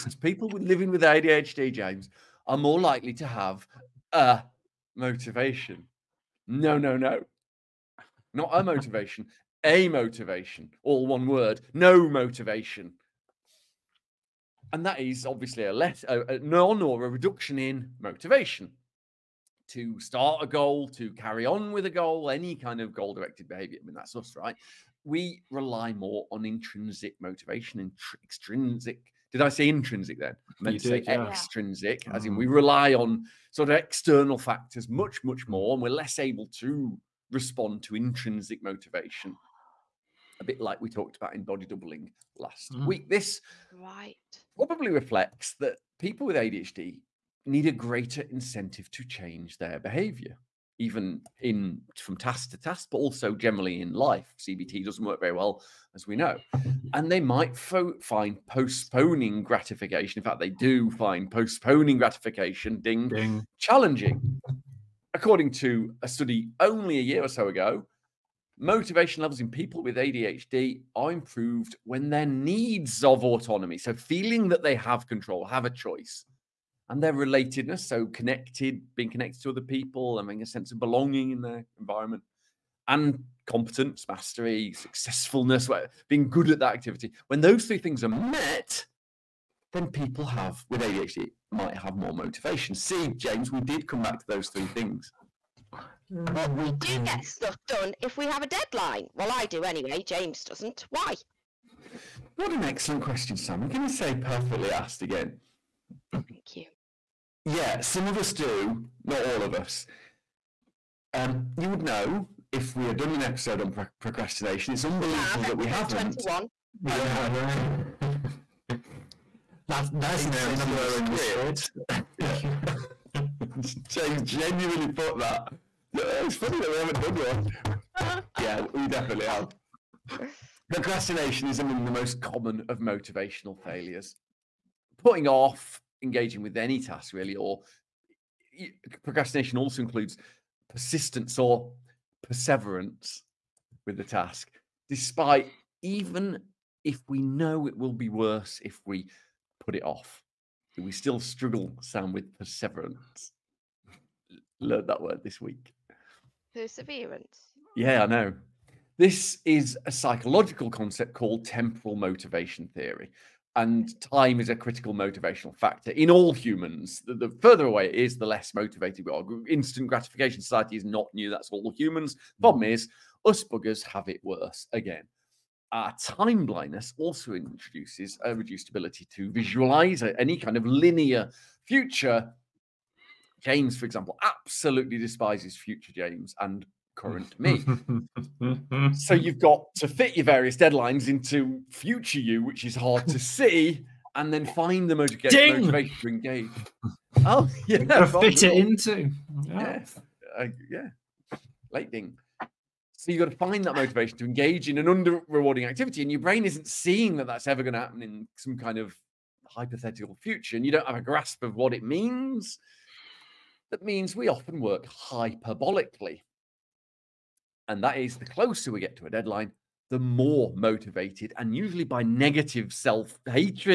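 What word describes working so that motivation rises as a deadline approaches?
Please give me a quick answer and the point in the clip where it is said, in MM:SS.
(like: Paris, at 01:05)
hyperbolically, at 03:34.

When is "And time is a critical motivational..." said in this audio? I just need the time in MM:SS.
02:43.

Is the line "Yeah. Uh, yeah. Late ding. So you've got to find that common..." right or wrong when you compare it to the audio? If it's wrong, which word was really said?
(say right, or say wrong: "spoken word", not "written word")
wrong: "motivation", not "common".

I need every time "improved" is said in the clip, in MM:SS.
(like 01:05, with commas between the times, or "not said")
01:11.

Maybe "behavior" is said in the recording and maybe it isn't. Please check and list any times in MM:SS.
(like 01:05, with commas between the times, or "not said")
00:23, 00:49.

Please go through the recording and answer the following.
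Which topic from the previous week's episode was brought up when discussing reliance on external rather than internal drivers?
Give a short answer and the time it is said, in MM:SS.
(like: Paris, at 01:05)
body doubling, at 00:41.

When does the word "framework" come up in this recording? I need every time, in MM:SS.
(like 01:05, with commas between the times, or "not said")
not said.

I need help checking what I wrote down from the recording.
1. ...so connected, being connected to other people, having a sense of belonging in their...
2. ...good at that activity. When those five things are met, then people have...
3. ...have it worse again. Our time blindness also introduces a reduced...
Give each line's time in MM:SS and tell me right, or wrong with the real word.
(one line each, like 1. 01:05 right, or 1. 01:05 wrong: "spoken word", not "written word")
1. 01:17 right
2. 01:26 wrong: "three", not "five"
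3. 02:53 right.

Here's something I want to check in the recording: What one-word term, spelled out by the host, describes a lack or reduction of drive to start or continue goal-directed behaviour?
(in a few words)
amotivation.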